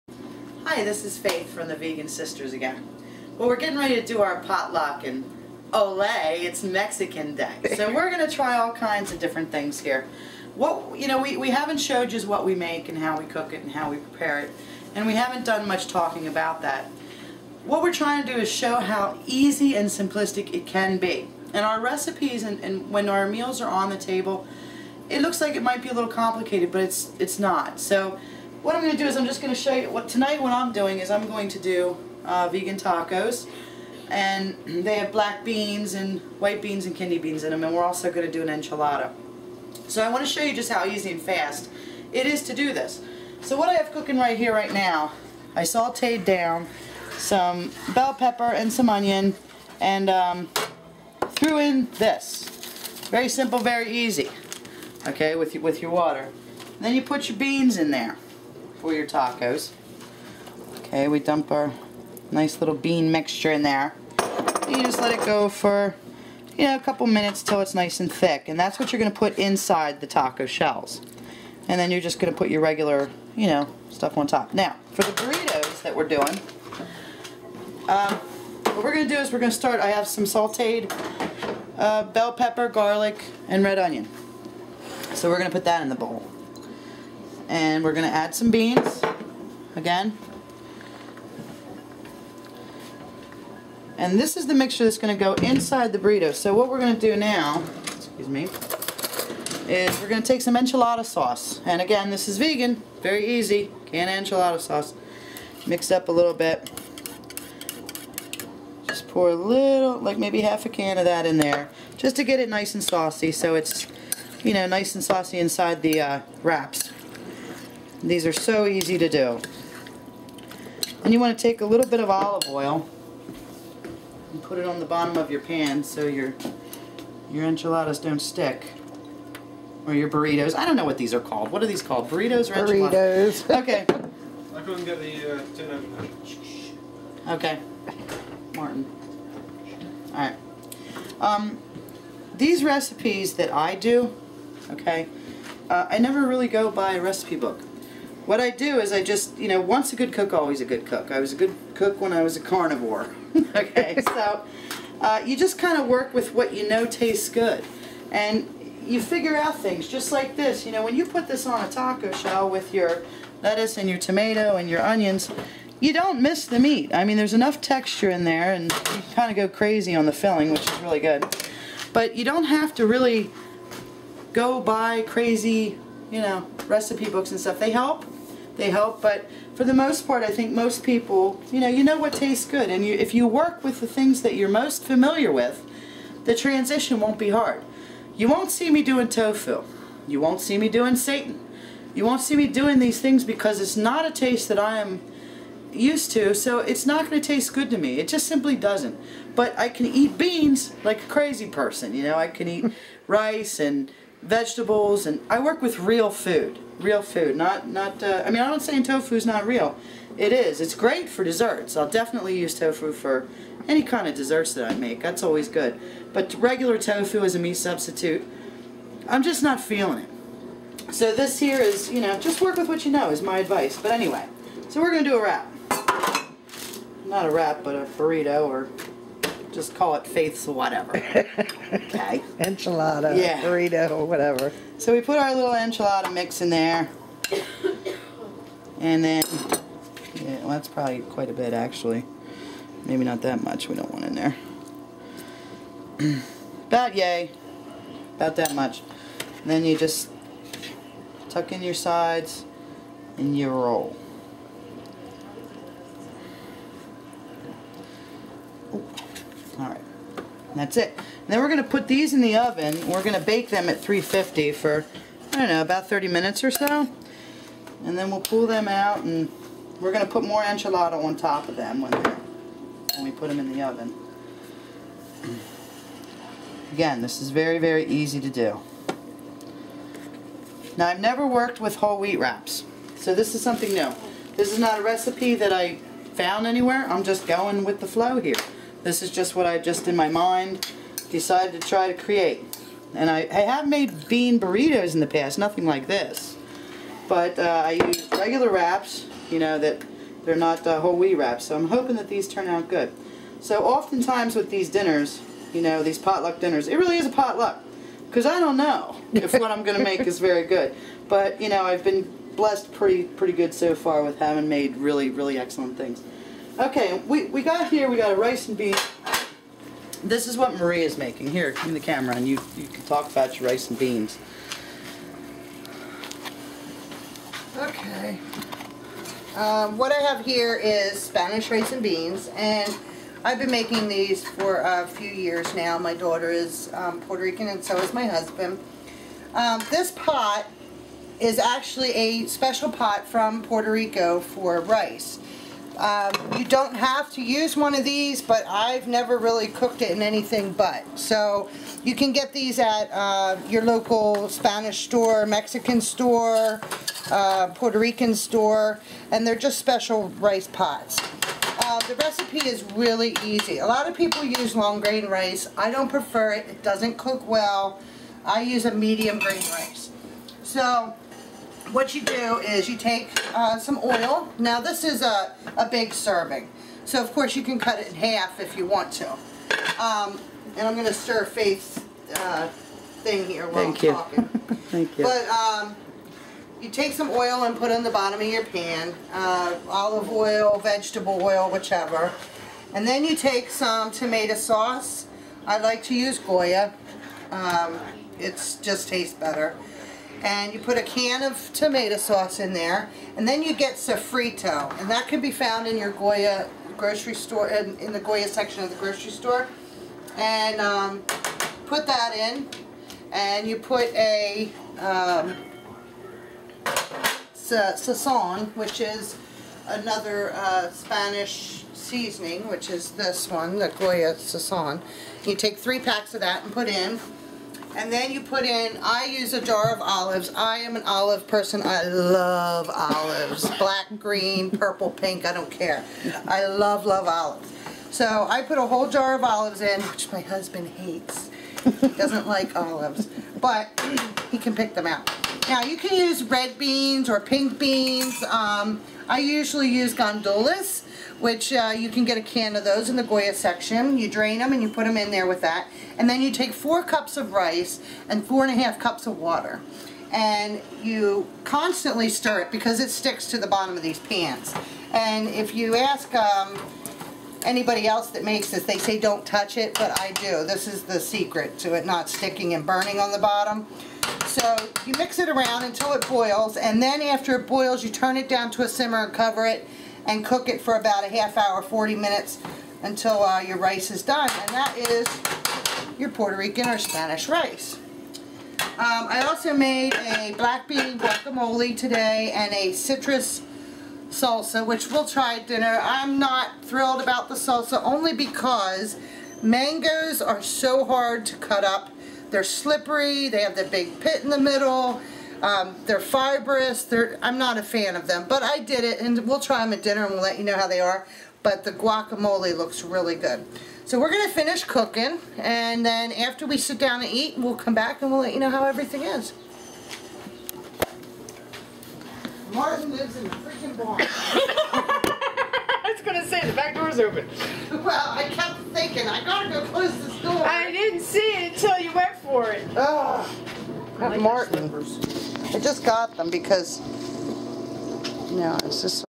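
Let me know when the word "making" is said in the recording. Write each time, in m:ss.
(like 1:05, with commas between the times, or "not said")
5:20, 5:33.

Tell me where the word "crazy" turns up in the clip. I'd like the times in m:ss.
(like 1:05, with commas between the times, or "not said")
2:49, 2:55, 3:21.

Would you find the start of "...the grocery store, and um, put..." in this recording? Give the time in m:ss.
6:48.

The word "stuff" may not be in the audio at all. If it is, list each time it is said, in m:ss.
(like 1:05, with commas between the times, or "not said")
1:13, 2:57.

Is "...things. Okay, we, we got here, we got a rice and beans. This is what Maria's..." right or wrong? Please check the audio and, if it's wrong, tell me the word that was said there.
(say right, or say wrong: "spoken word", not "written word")
right.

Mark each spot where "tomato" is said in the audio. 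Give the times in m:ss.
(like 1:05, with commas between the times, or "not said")
2:43, 6:33, 6:41.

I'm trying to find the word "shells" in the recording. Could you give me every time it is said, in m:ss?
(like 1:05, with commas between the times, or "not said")
1:10, 2:42.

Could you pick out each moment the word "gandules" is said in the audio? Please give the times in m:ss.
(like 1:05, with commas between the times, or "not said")
7:29.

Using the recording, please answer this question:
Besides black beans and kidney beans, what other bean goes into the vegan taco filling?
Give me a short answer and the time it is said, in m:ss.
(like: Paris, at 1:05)
white beans, at 0:36.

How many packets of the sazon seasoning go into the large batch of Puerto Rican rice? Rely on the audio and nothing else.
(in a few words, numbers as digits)
3.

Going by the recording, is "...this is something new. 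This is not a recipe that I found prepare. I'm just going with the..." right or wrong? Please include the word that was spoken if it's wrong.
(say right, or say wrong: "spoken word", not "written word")
wrong: "anywhere", not "prepare".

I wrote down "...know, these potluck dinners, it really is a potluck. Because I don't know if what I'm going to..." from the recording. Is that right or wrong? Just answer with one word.
right.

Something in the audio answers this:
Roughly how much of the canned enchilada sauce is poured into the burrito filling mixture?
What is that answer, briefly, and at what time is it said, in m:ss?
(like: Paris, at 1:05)
half a can, at 1:50.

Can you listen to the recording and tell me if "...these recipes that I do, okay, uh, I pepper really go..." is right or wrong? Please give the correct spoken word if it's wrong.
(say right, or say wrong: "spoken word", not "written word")
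wrong: "never", not "pepper".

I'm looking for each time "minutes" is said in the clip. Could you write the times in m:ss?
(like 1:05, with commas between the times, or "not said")
1:07, 4:26, 8:01.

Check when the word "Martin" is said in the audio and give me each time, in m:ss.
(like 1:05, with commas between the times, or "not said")
2:18, 8:42, 8:54.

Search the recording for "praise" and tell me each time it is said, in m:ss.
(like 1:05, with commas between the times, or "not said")
not said.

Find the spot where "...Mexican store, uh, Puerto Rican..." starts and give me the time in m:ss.
5:55.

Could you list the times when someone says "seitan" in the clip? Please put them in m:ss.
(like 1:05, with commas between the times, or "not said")
3:10.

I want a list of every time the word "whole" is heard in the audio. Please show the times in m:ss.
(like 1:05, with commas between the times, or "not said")
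4:41, 5:00, 7:18.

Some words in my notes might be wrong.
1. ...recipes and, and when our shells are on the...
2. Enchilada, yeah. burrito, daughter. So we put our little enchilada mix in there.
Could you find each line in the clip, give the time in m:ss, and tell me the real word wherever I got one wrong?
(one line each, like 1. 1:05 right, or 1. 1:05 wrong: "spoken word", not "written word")
1. 0:21 wrong: "meals", not "shells"
2. 3:52 wrong: "whatever", not "daughter".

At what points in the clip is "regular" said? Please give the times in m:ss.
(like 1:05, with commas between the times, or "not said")
1:12, 3:36, 4:58.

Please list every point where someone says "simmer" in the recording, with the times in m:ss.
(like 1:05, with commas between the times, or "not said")
7:58.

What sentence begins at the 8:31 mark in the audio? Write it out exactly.
But the guacamole looks really good.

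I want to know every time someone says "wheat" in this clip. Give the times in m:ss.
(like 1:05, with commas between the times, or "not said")
4:41, 5:00.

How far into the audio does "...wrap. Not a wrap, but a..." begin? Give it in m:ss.
3:45.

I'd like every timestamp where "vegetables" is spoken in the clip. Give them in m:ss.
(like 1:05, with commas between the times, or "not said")
3:24, 6:30.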